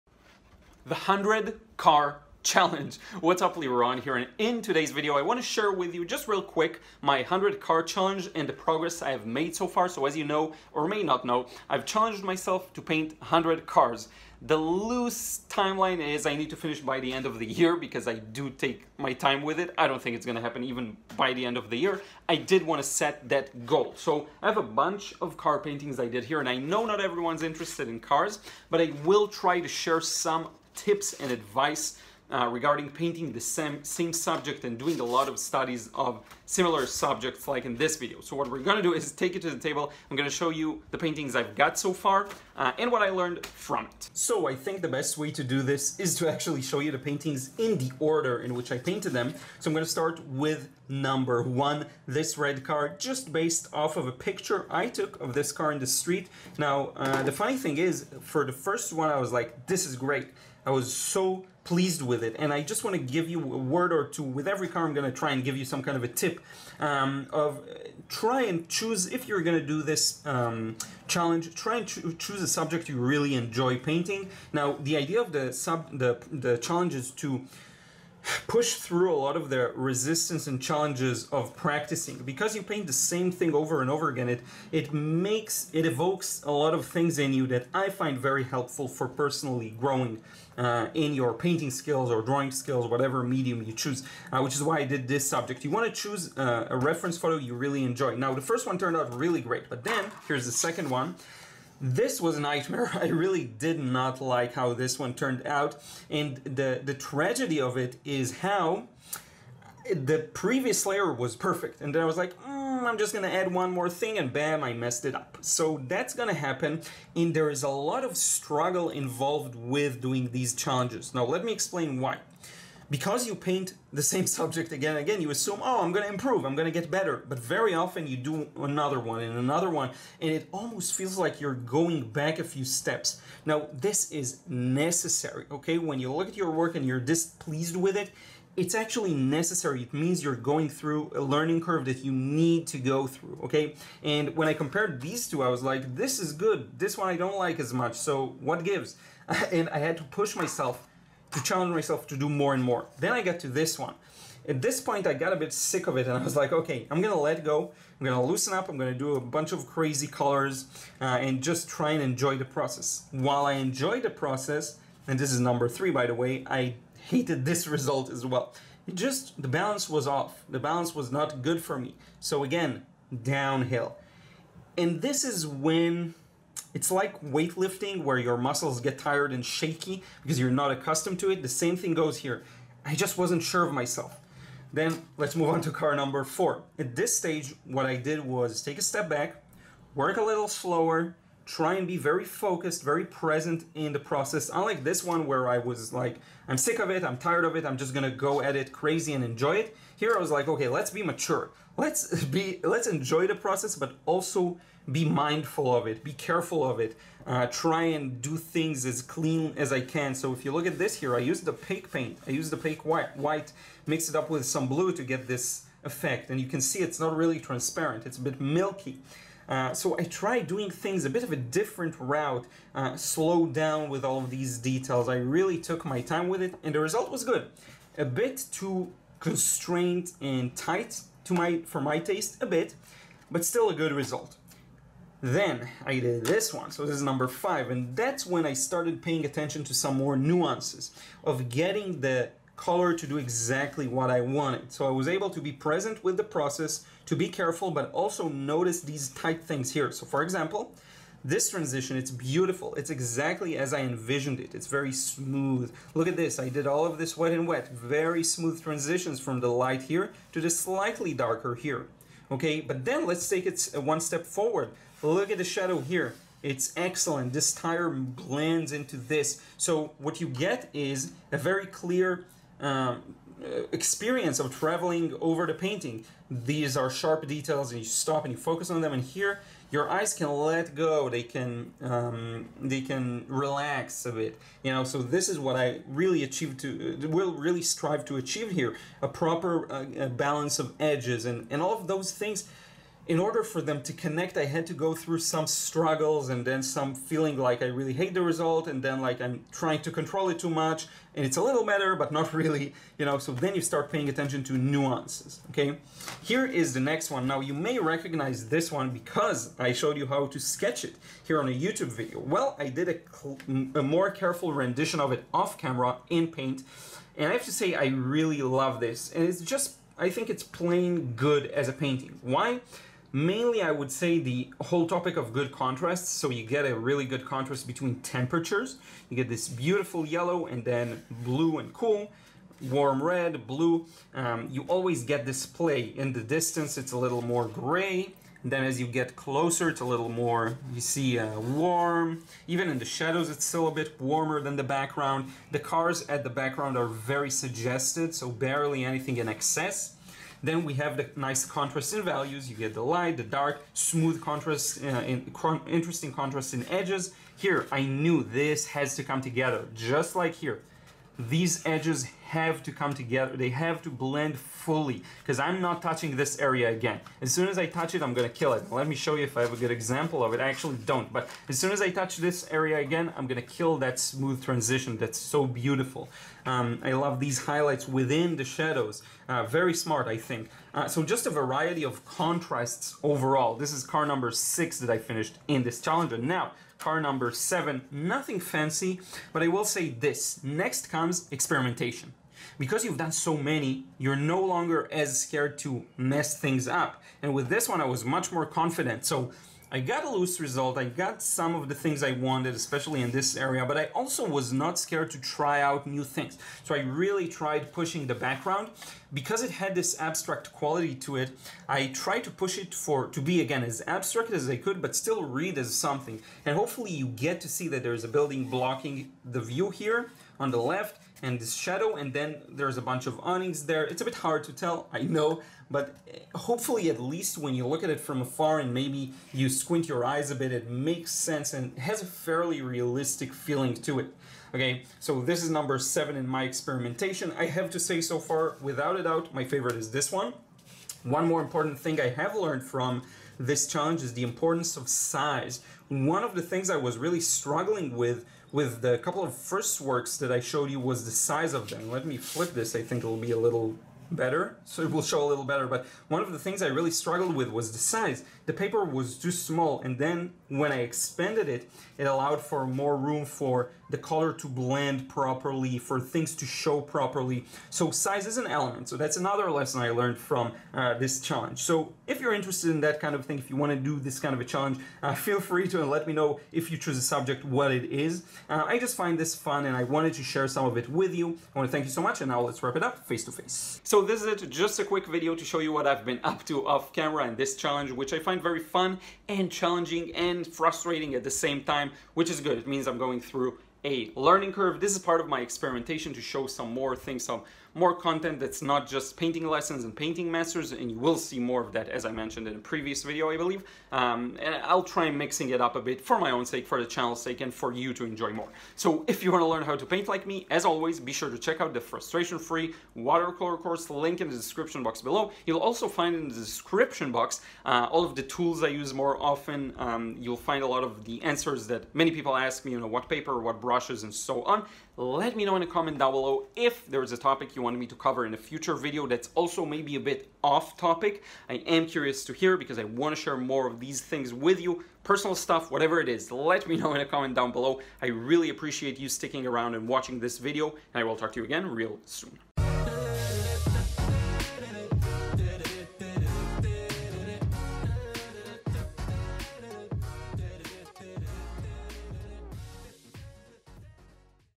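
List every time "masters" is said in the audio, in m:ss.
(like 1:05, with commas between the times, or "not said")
8:20.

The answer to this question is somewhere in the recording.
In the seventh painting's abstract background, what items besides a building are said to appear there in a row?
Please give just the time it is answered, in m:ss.
7:03.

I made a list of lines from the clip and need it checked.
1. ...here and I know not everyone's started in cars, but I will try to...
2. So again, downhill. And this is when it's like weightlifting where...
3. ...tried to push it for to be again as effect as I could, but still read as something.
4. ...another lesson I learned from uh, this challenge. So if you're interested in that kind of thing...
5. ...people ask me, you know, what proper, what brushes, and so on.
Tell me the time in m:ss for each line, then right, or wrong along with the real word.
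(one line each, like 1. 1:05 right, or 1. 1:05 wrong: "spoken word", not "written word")
1. 0:26 wrong: "interested", not "started"
2. 2:52 right
3. 6:51 wrong: "abstract", not "effect"
4. 7:49 right
5. 8:42 wrong: "paper", not "proper".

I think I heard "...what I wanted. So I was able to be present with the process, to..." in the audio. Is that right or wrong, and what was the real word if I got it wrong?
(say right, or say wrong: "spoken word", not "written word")
right.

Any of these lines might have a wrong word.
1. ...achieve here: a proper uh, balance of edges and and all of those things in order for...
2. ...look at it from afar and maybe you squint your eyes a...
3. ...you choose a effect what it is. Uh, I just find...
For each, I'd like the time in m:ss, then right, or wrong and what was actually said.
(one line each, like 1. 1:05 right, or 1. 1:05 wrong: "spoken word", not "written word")
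1. 4:48 right
2. 7:07 right
3. 7:56 wrong: "subject", not "effect".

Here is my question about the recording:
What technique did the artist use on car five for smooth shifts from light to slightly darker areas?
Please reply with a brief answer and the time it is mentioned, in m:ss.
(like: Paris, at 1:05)
Wet and wet, at 4:17.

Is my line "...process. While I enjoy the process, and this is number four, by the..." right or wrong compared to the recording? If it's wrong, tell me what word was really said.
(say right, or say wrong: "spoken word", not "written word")
wrong: "three", not "four".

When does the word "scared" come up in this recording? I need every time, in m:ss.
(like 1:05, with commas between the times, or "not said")
6:35, 6:44.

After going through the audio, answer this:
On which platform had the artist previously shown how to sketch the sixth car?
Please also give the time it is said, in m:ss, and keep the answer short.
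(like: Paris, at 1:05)
YouTube, at 5:11.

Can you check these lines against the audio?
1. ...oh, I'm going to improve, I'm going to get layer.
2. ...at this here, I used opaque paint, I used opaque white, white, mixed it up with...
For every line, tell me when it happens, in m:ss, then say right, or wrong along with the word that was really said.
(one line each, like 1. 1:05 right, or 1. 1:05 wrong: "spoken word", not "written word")
1. 2:05 wrong: "better", not "layer"
2. 3:30 right.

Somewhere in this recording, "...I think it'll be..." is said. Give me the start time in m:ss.
7:32.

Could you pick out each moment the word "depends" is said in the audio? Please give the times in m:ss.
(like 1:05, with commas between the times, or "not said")
not said.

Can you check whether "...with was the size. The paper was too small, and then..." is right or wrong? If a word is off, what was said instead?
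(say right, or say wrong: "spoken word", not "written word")
right.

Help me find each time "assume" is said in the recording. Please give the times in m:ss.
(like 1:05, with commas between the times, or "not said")
2:05.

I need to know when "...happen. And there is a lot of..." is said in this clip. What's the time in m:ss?
1:56.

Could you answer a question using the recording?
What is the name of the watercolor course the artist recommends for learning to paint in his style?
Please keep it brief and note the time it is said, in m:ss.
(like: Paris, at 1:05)
Frustration-free watercolor course, at 8:31.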